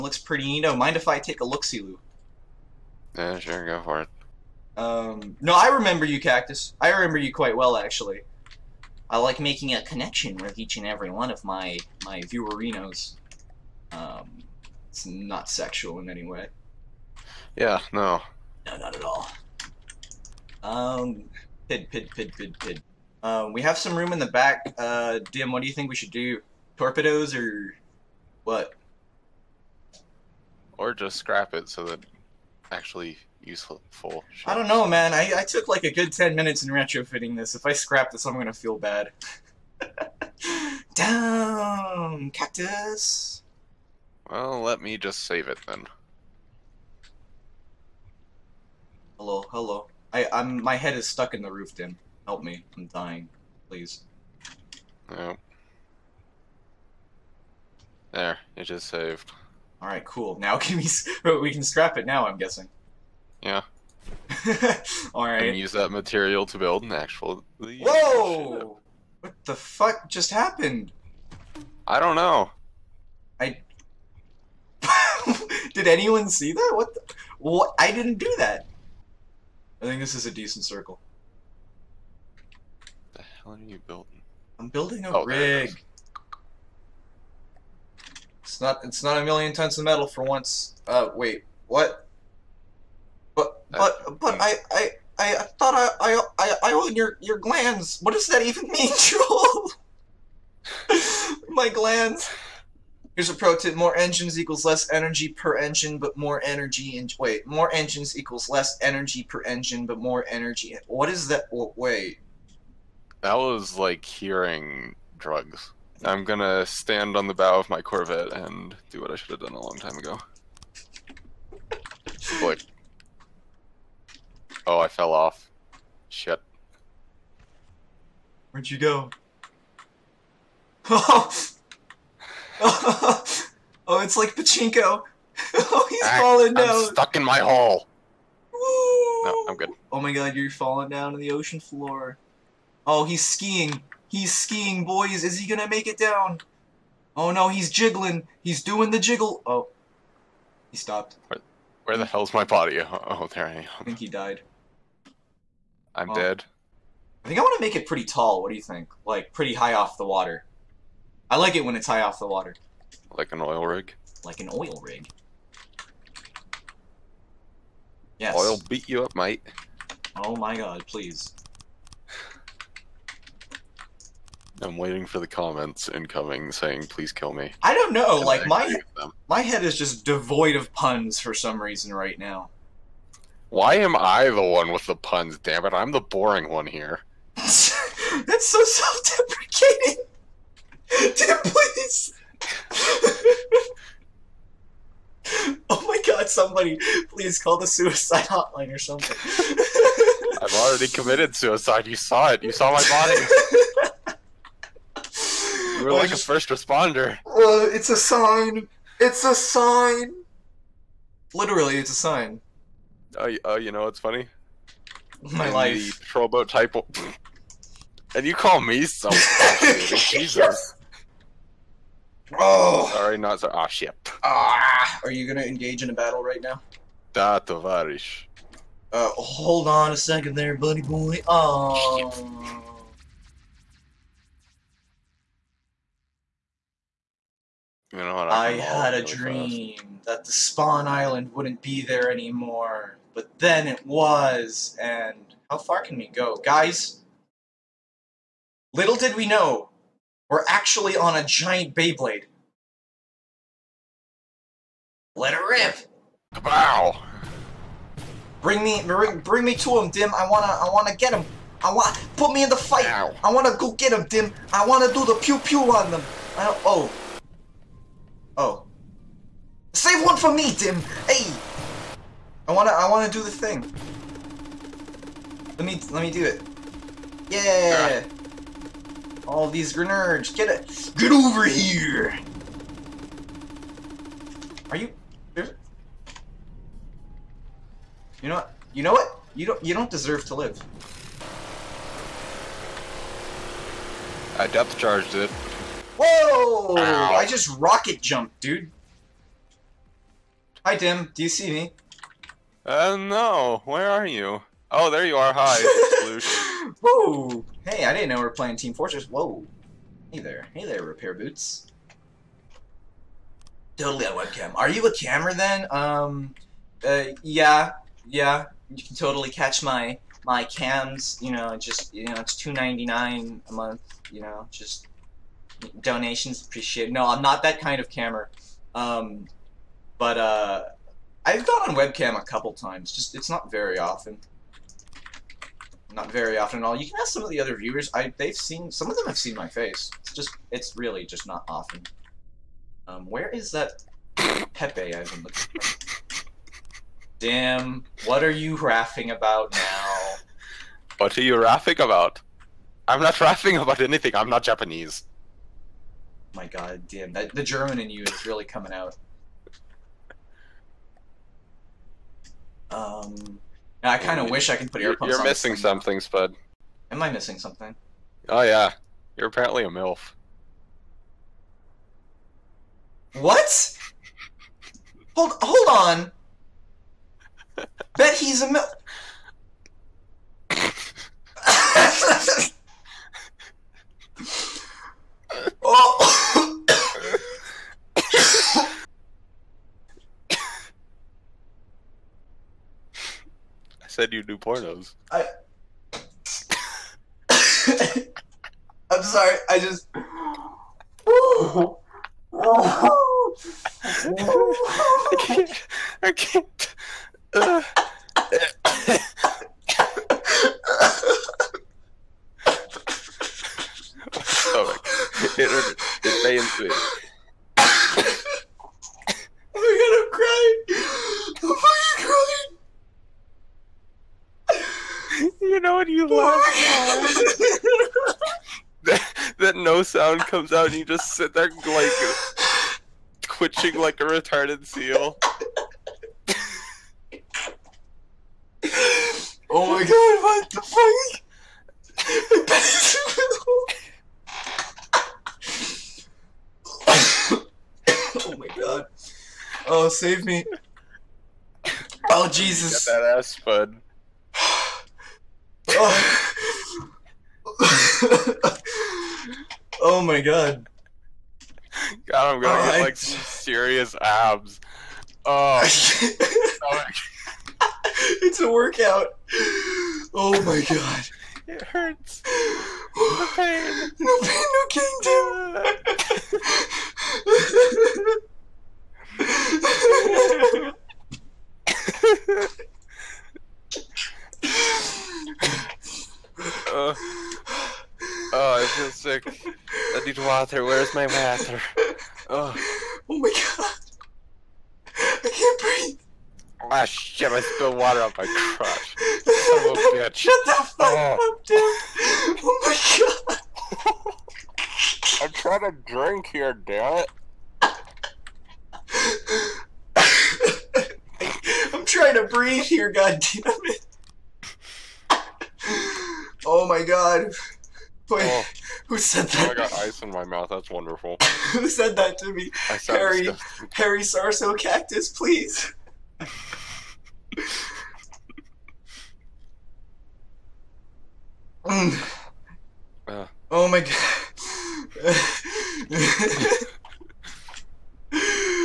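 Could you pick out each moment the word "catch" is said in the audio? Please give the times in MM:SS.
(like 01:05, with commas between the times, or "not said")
05:19.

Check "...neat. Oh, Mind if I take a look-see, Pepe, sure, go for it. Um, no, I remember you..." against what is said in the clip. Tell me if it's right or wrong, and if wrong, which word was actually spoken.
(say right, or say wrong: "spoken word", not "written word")
wrong: "Yeah", not "Pepe".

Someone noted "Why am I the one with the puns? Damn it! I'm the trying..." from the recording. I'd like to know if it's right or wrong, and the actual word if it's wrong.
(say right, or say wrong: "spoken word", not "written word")
wrong: "boring", not "trying".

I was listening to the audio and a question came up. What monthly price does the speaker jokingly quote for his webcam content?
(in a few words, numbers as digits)
2.99.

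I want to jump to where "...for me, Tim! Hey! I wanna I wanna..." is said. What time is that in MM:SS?
04:30.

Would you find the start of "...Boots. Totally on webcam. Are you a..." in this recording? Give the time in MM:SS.
05:11.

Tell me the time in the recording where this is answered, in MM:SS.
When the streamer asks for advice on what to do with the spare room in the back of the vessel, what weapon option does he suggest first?
00:26.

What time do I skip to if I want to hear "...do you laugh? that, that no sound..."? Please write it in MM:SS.
07:05.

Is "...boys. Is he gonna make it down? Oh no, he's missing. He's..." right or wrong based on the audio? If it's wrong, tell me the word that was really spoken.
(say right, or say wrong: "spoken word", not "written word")
wrong: "jiggling", not "missing".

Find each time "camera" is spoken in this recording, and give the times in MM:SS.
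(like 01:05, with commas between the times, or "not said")
05:14, 05:27.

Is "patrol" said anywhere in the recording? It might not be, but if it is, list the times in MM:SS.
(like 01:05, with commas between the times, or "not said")
03:36.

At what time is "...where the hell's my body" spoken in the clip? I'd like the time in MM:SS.
02:31.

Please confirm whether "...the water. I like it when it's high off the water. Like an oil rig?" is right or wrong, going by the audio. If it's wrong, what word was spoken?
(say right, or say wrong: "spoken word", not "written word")
right.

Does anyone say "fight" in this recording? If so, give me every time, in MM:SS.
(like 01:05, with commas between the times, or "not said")
04:22.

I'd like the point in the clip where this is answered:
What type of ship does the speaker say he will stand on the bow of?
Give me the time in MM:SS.
01:57.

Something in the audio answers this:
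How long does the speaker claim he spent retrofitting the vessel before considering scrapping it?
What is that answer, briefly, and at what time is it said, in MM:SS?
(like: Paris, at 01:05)
10 minutes, at 00:36.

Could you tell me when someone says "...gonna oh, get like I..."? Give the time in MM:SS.
07:42.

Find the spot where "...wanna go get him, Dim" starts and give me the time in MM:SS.
04:23.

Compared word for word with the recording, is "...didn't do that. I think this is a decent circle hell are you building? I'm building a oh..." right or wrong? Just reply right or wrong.
right.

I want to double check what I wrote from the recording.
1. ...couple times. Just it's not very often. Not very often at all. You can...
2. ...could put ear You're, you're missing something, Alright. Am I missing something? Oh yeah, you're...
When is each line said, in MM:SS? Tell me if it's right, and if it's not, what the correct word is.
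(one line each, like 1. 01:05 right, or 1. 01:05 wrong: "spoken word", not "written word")
1. 05:32 right
2. 06:04 wrong: "Spud", not "Alright".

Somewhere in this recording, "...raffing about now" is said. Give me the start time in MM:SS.
05:48.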